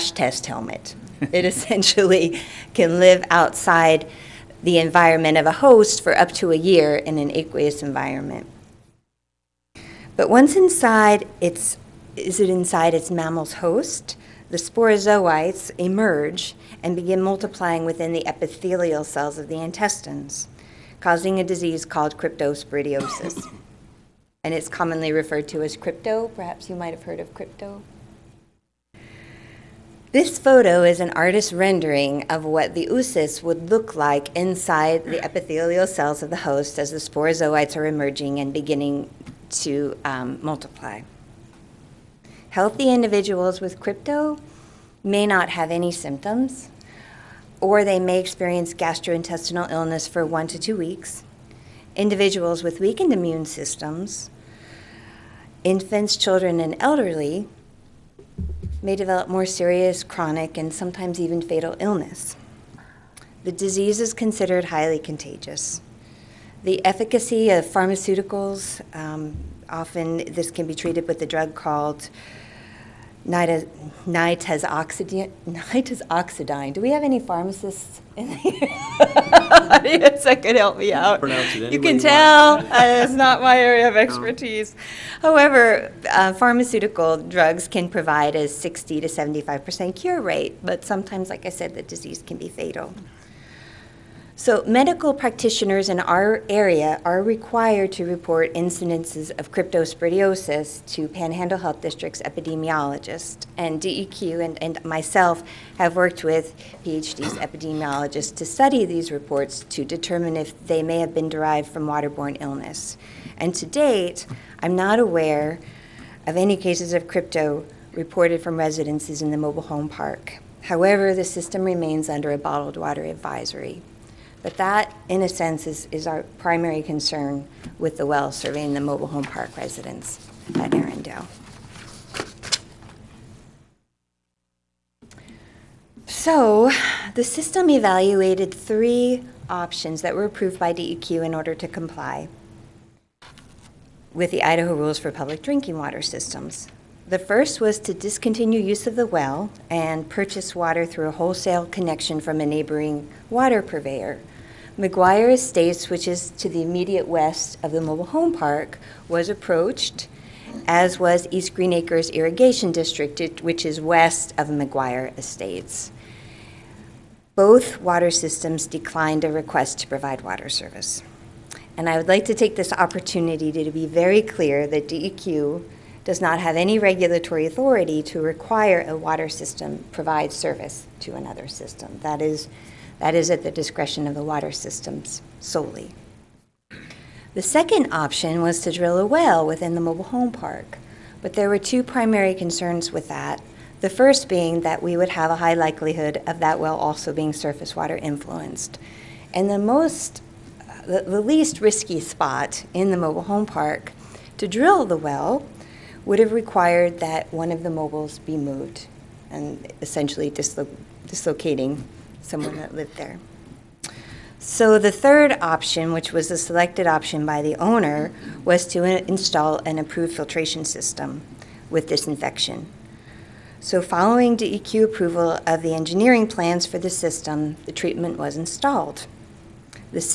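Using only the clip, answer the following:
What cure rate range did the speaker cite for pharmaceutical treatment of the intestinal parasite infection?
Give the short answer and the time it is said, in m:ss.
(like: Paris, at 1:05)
60 to 75 percent, at 1:28.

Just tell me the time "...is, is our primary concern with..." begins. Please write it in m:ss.
2:05.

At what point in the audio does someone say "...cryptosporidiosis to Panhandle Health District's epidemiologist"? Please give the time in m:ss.
1:39.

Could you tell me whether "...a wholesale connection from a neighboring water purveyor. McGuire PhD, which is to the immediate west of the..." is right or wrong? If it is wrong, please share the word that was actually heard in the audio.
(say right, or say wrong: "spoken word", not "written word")
wrong: "Estates", not "PhD".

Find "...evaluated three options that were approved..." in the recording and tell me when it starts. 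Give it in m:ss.
2:17.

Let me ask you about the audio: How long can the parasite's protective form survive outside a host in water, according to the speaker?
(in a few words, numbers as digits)
up to a year.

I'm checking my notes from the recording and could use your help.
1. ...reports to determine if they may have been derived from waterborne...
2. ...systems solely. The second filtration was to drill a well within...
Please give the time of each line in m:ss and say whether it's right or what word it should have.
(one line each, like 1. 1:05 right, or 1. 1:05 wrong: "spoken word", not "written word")
1. 1:49 right
2. 3:04 wrong: "option", not "filtration".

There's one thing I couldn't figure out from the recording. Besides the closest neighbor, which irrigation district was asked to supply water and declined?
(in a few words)
East Green Acres Irrigation District.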